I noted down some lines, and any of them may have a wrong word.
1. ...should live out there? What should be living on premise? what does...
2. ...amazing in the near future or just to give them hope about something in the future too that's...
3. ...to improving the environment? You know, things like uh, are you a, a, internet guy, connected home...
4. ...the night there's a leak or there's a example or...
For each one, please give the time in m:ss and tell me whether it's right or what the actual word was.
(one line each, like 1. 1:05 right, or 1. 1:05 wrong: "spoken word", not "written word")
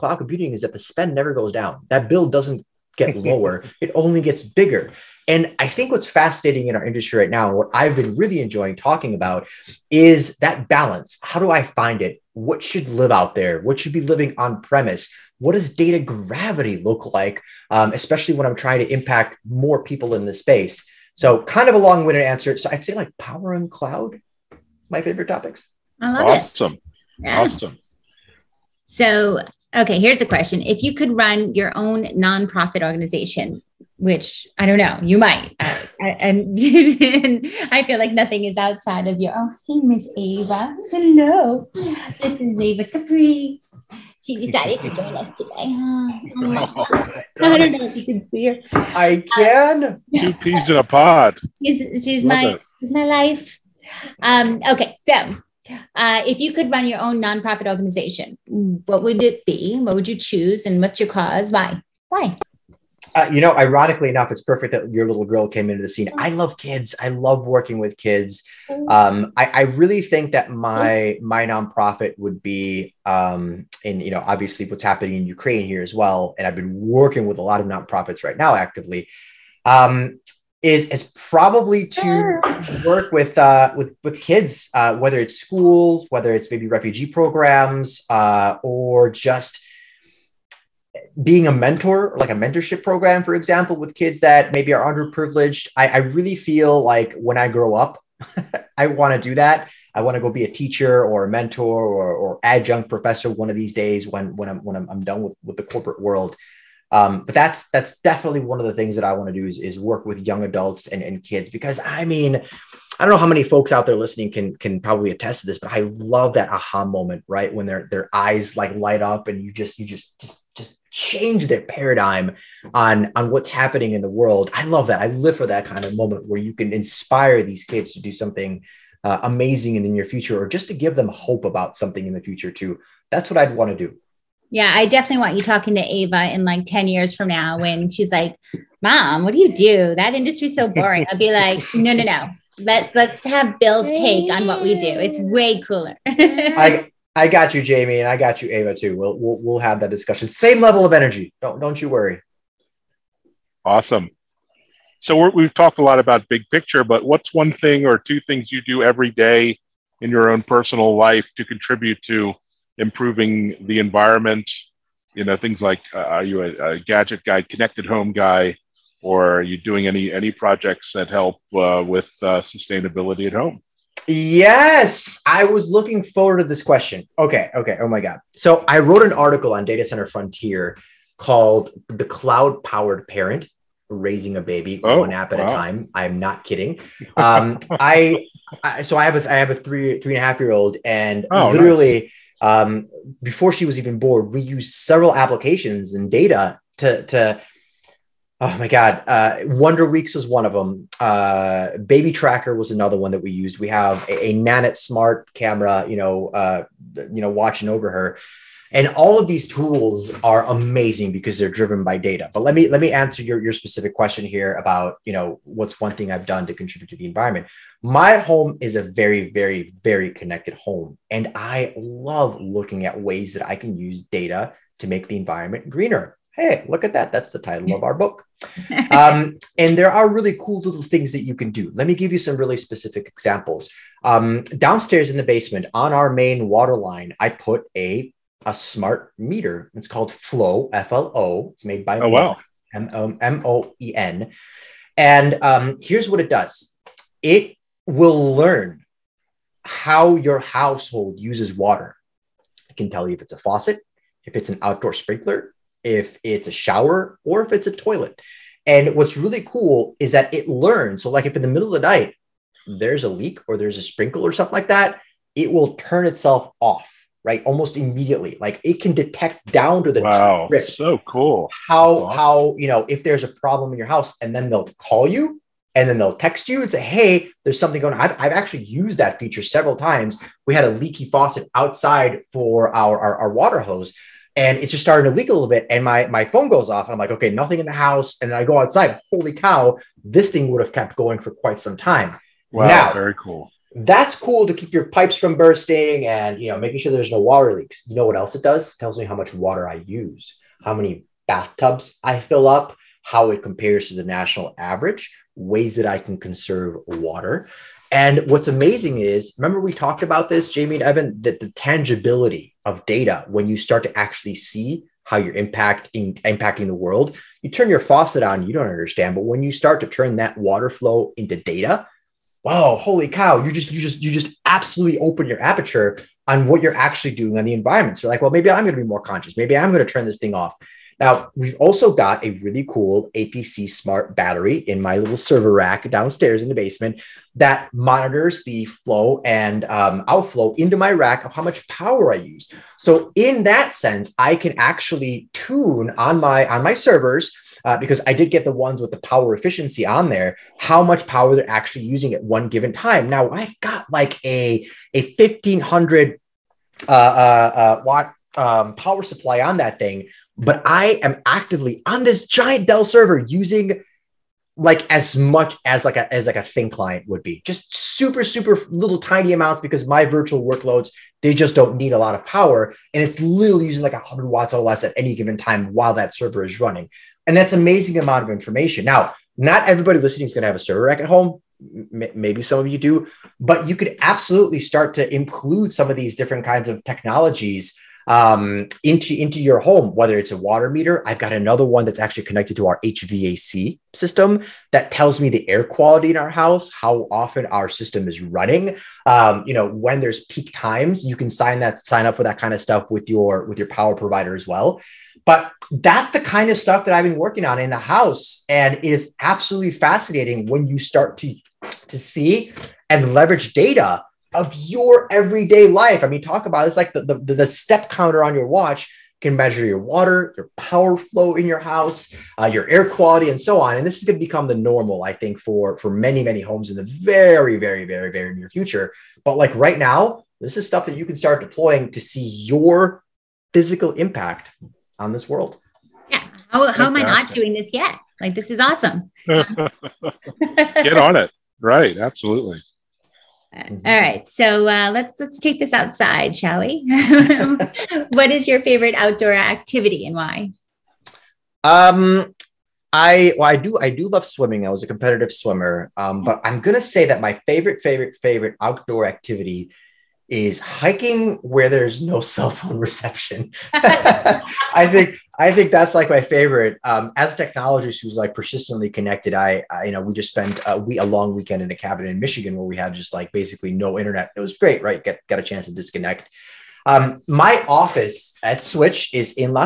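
1. 0:12 right
2. 2:09 right
3. 2:42 wrong: "gadget", not "internet"
4. 4:21 wrong: "sprinkle", not "example".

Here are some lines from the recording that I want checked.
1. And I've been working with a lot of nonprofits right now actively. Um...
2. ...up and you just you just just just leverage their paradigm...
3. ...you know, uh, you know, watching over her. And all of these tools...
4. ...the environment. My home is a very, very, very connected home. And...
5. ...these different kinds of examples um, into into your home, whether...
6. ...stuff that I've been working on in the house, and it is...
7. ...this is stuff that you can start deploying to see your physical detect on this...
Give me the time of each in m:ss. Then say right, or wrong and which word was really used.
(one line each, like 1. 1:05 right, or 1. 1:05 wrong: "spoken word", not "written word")
1. 1:16 right
2. 1:59 wrong: "change", not "leverage"
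3. 3:25 right
4. 3:36 right
5. 6:25 wrong: "technologies", not "examples"
6. 6:46 right
7. 7:10 wrong: "impact", not "detect".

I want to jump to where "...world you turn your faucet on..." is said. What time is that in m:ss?
5:16.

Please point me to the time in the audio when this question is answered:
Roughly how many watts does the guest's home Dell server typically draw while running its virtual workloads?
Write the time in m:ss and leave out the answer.
6:13.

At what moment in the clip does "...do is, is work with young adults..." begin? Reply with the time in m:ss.
1:49.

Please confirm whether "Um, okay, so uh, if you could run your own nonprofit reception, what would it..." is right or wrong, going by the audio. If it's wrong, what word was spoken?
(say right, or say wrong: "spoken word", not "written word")
wrong: "organization", not "reception".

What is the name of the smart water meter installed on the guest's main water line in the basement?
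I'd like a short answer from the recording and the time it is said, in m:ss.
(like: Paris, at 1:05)
Flo, at 4:00.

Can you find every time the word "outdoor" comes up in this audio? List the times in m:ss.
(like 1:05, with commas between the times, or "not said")
4:14, 7:28, 7:38.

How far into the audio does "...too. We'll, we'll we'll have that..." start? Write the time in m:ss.
2:28.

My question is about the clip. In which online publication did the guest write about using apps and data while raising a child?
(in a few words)
Data Center Frontier.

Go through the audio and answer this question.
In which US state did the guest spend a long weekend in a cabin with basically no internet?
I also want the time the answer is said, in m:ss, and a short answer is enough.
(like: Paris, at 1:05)
Michigan, at 7:52.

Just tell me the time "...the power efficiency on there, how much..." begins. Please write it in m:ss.
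5:48.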